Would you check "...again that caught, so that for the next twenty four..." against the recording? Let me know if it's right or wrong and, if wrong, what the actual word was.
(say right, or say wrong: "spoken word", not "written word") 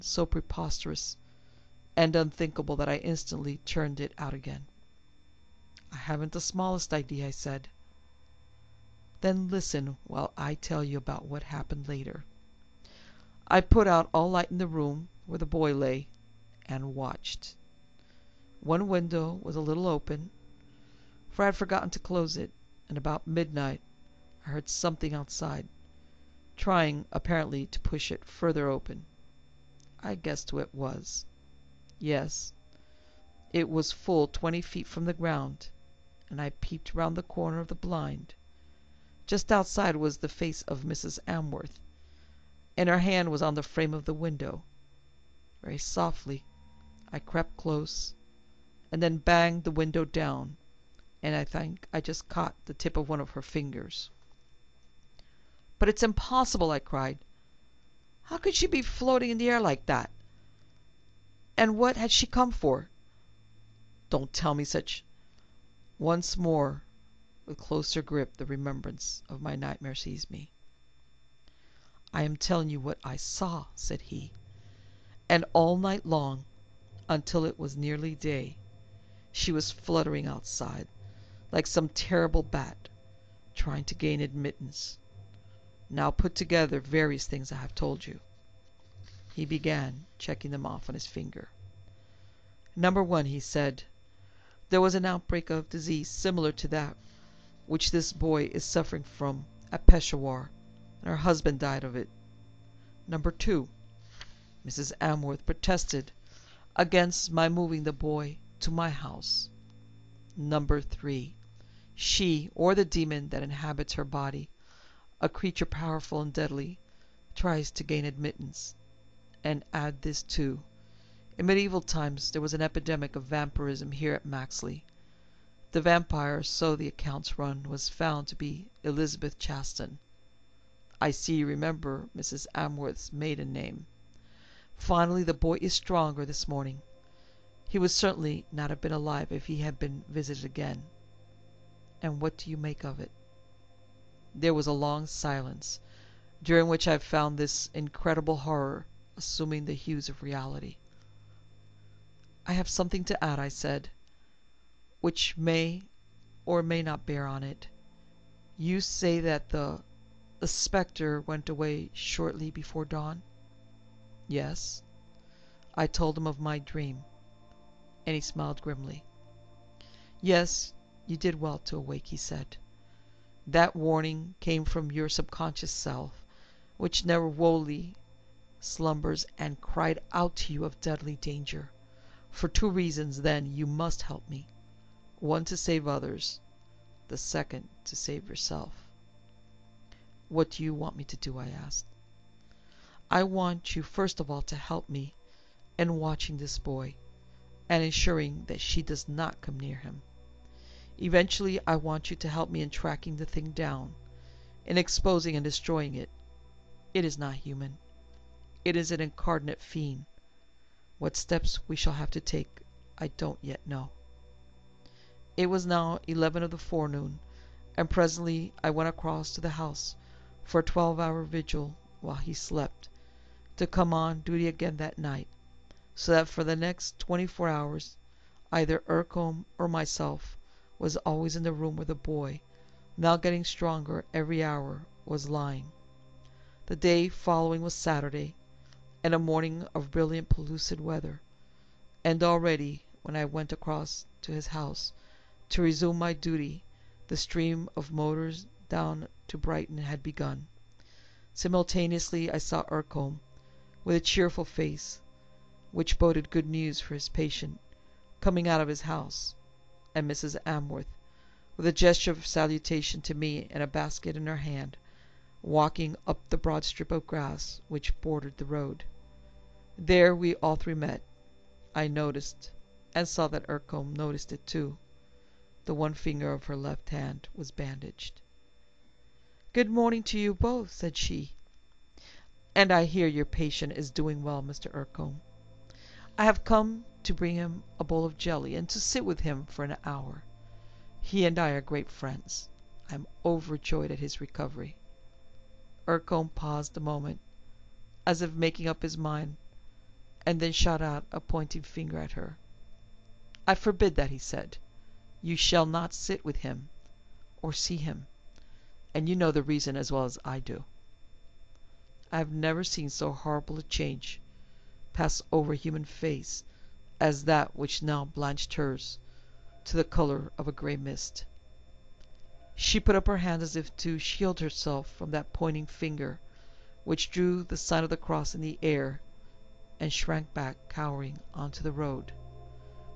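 wrong: "night", not "caught".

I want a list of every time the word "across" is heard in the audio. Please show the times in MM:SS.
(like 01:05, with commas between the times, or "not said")
03:38, 04:03.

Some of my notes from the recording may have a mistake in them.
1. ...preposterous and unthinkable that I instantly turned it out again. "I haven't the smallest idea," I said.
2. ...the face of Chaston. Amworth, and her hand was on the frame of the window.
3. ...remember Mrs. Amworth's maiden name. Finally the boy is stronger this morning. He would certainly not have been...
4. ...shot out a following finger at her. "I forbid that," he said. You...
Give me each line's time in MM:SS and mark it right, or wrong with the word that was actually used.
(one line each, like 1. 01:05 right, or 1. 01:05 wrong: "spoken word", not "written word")
1. 00:00 right
2. 00:40 wrong: "Mrs", not "Chaston"
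3. 02:11 right
4. 05:00 wrong: "pointing", not "following".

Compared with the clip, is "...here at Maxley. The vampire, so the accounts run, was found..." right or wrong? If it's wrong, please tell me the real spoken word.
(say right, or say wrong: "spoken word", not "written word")
right.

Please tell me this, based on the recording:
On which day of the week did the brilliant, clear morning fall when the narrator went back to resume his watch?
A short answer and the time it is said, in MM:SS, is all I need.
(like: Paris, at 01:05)
Saturday, at 03:57.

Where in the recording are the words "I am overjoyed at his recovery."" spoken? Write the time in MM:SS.
04:52.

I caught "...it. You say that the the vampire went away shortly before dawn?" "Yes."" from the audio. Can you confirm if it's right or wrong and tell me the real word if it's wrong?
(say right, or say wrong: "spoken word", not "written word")
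wrong: "spectre", not "vampire".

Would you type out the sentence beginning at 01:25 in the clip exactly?
Now put together various things I have told you." He began checking them off on his finger.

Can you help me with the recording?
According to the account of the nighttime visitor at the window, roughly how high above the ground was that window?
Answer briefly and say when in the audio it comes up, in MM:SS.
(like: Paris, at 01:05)
20 feet, at 00:34.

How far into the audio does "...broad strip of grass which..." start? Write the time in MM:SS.
04:26.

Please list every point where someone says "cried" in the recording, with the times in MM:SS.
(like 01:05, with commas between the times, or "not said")
00:56, 02:59.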